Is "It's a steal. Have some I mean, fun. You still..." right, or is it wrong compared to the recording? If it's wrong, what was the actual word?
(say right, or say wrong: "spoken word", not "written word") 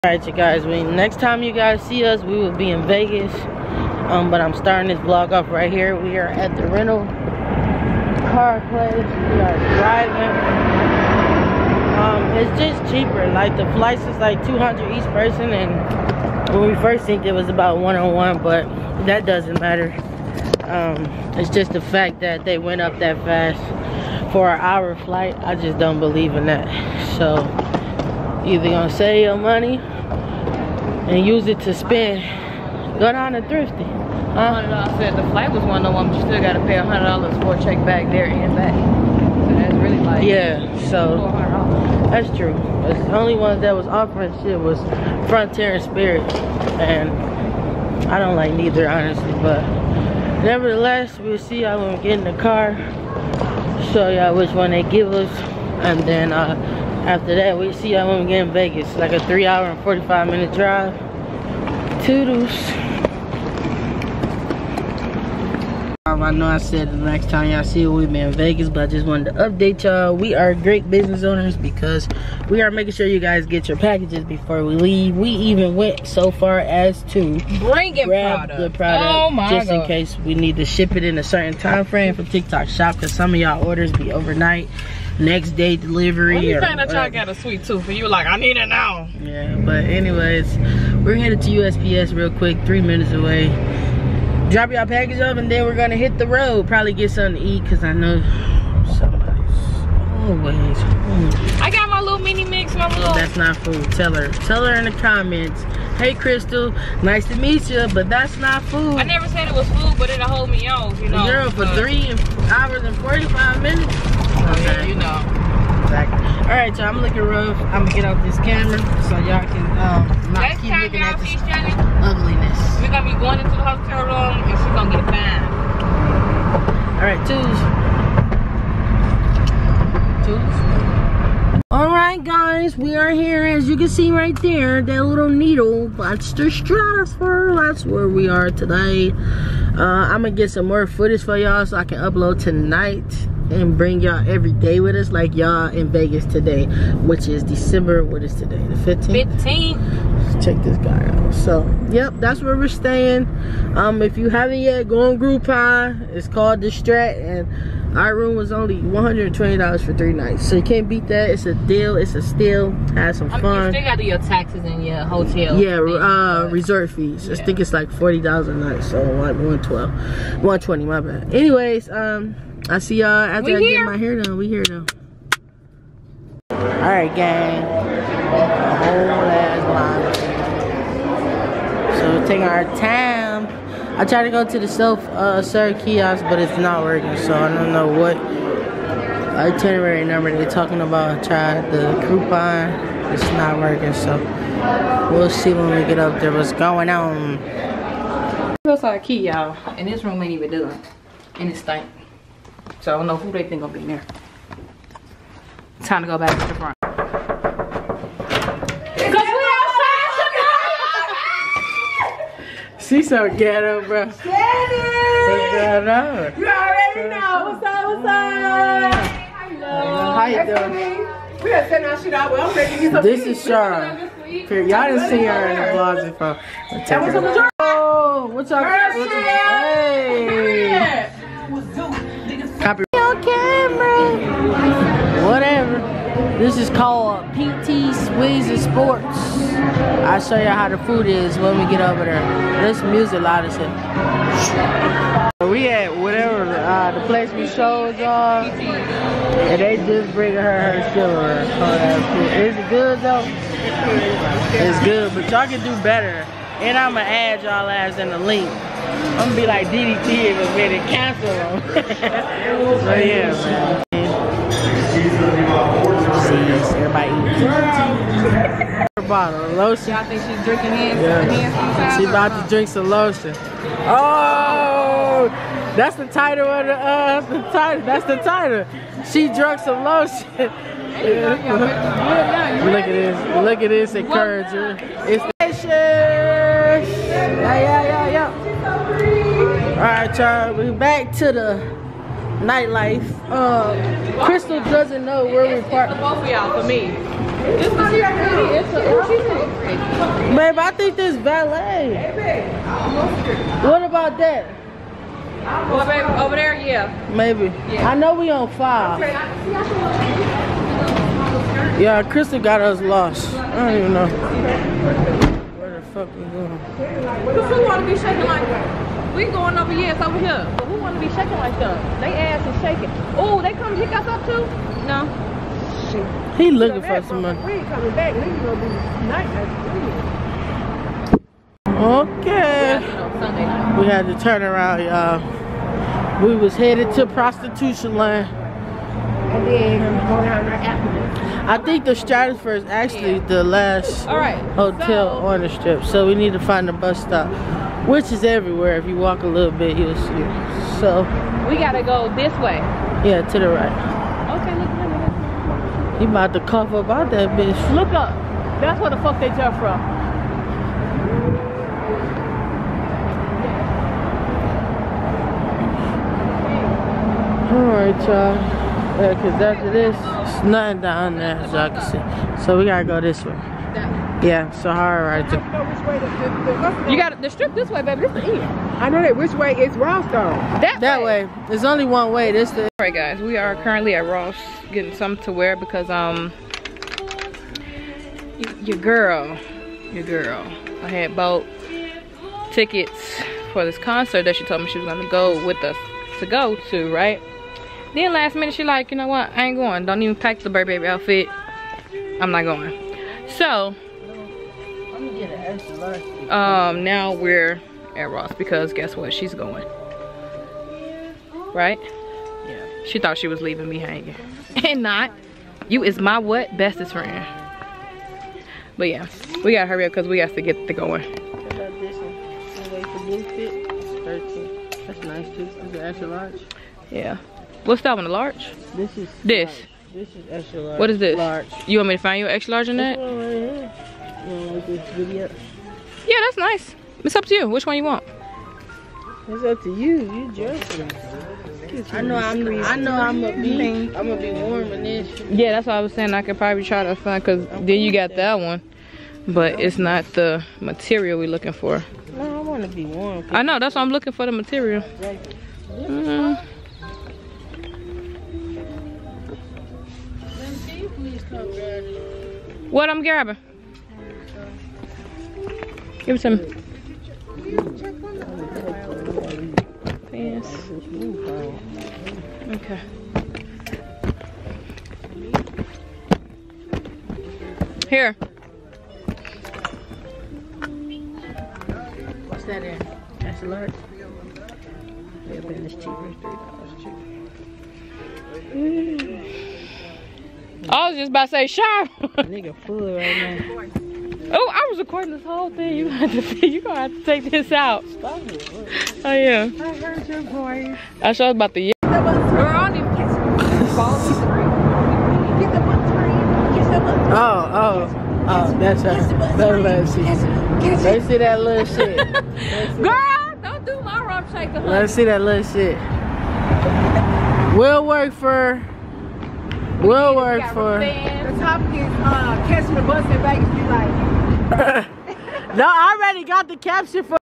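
right.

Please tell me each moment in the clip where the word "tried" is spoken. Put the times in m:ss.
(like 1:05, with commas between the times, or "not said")
3:04, 3:11.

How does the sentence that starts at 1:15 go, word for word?
We even went so far as to bring it grab product.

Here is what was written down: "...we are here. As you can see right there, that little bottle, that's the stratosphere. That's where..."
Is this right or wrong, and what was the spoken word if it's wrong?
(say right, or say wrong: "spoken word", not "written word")
wrong: "needle", not "bottle".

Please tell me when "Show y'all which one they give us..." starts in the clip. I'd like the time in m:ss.
0:53.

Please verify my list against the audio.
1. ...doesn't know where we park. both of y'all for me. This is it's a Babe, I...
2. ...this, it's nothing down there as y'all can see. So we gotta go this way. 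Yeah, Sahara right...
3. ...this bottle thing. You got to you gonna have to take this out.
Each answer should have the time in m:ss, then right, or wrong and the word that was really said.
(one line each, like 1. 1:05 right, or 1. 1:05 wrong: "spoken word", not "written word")
1. 4:54 right
2. 6:09 right
3. 8:15 wrong: "whole", not "bottle".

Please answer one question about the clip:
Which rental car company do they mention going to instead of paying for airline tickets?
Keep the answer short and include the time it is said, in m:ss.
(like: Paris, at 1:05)
Thrifty, at 0:33.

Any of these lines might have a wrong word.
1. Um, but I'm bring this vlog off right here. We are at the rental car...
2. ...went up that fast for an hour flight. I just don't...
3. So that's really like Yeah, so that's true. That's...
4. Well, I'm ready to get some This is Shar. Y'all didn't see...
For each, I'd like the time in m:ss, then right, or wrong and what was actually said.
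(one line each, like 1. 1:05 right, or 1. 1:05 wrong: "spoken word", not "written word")
1. 0:04 wrong: "starting", not "bring"
2. 0:22 right
3. 0:39 right
4. 3:42 right.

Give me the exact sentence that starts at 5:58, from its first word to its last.
That's where the fuck they jump from.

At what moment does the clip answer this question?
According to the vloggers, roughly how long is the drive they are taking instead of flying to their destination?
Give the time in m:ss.
0:59.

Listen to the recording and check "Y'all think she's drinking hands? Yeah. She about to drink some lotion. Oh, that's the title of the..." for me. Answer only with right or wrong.
right.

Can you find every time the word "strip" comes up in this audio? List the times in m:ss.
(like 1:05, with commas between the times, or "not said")
5:45, 6:17.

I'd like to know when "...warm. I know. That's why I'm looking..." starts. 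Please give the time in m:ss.
7:32.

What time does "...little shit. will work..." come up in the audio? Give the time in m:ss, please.
8:35.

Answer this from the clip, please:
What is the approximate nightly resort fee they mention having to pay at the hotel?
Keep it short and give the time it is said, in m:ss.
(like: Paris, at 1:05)
$40, at 2:47.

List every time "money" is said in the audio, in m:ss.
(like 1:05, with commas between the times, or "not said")
0:29, 5:27.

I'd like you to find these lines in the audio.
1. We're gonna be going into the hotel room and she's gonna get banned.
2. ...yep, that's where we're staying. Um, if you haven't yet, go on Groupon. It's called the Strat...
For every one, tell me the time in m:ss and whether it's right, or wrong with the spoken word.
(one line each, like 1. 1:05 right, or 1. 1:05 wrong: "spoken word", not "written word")
1. 2:02 right
2. 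2:31 right.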